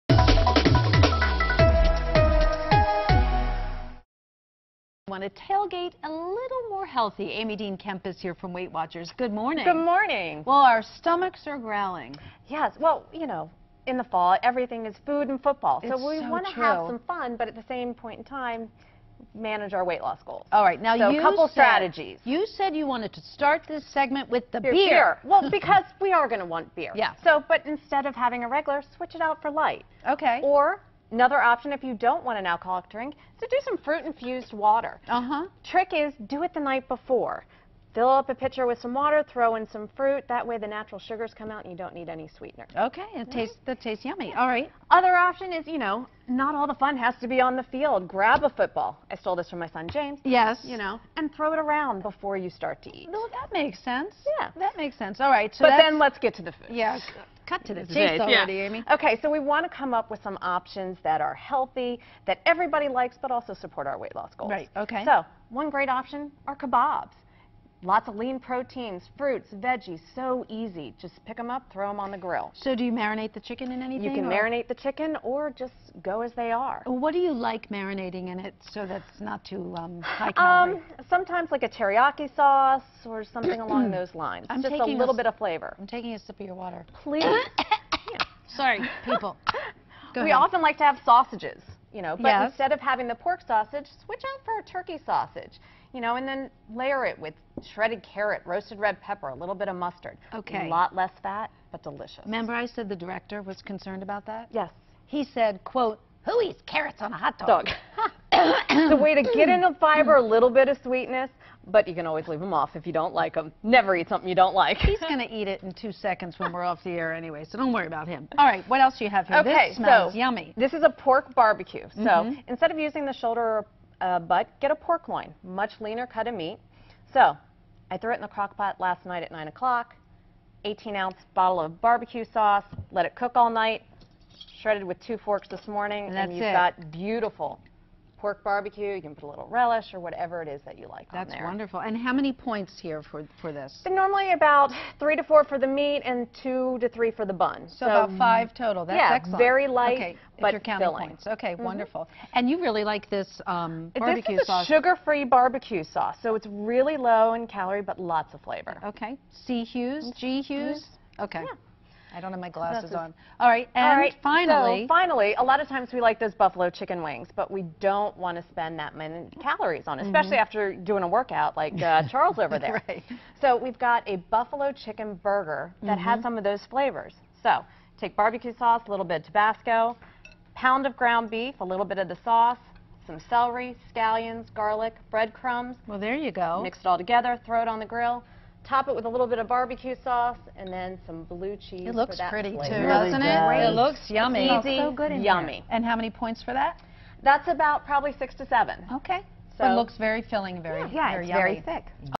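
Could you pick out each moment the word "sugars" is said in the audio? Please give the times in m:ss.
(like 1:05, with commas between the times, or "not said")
0:40, 2:34.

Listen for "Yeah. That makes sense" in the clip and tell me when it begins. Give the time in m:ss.
0:54.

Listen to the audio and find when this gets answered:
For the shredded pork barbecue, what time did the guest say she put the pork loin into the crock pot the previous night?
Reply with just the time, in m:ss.
2:09.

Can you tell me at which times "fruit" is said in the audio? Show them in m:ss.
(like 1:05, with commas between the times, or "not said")
0:33, 0:39, 1:09.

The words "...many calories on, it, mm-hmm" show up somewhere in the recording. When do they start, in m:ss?
2:48.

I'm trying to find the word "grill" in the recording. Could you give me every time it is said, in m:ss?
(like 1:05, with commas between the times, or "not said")
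1:12, 3:07.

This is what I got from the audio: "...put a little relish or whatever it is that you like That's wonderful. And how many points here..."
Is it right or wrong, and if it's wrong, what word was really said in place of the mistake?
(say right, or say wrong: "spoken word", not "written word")
right.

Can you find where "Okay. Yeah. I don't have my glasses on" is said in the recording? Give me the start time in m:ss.
2:41.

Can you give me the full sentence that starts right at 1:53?
Never eat something you don't like.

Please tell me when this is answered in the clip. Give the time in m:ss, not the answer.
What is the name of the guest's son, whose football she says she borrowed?
0:49.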